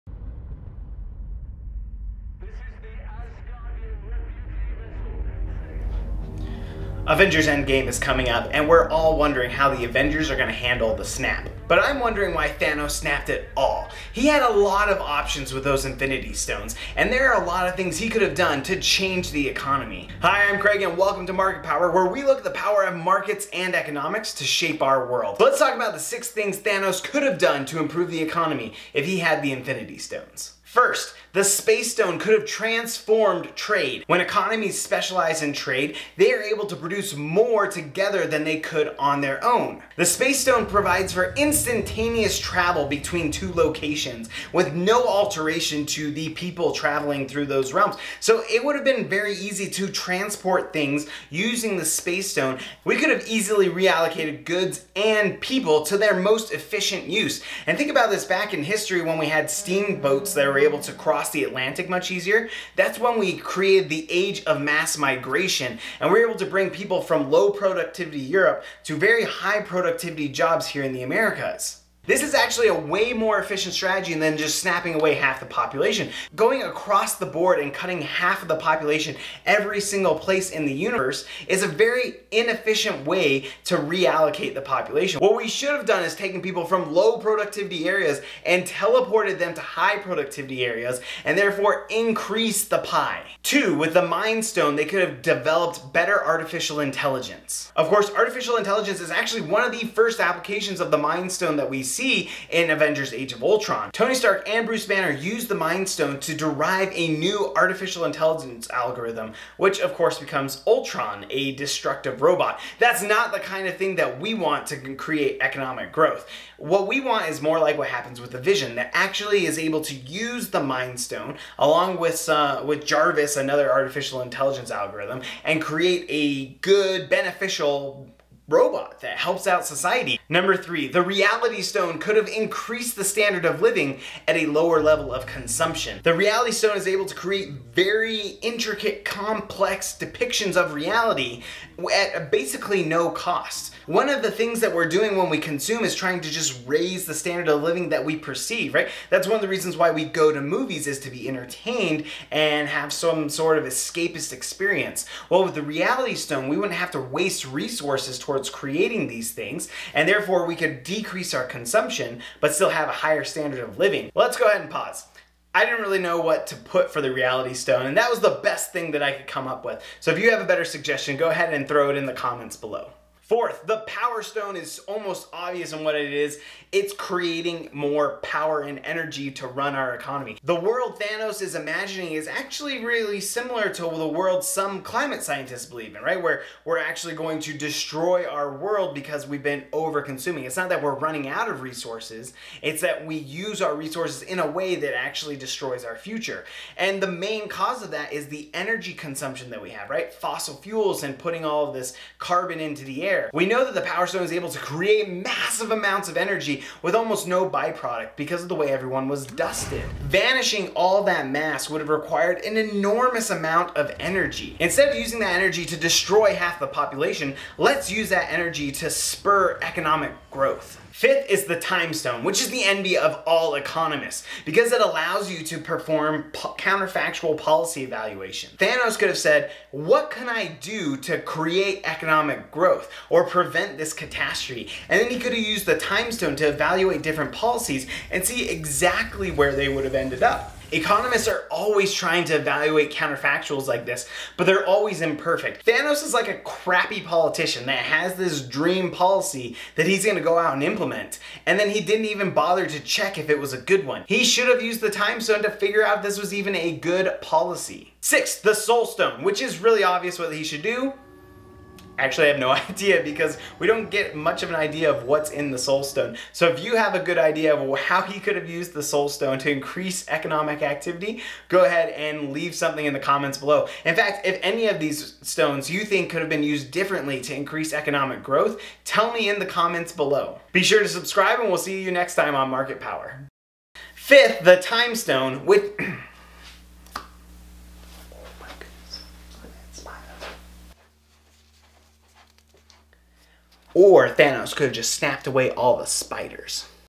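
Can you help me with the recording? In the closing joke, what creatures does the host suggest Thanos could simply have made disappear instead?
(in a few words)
Spiders.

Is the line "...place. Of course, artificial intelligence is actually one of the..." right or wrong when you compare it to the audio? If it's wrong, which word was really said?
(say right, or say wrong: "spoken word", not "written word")
wrong: "intelligence", not "place".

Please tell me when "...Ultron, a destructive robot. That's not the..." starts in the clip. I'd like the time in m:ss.
1:50.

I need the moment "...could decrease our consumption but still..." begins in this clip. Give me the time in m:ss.
2:40.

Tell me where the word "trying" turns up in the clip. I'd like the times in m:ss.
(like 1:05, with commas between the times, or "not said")
2:25, 4:01.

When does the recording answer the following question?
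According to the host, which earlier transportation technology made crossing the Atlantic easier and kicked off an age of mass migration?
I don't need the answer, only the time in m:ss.
0:59.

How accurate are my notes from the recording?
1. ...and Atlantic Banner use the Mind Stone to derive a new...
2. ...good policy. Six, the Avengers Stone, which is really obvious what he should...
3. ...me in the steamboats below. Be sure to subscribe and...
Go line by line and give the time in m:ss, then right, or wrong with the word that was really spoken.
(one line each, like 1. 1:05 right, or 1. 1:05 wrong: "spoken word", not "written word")
1. 1:44 wrong: "Bruce", not "Atlantic"
2. 4:16 wrong: "Soul", not "Avengers"
3. 4:39 wrong: "comments", not "steamboats".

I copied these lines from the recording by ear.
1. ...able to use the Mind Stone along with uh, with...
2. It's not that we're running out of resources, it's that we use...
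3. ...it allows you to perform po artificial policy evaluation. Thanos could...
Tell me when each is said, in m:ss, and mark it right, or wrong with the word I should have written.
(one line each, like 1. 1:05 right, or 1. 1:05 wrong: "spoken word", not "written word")
1. 1:59 right
2. 3:10 right
3. 3:44 wrong: "counterfactual", not "artificial".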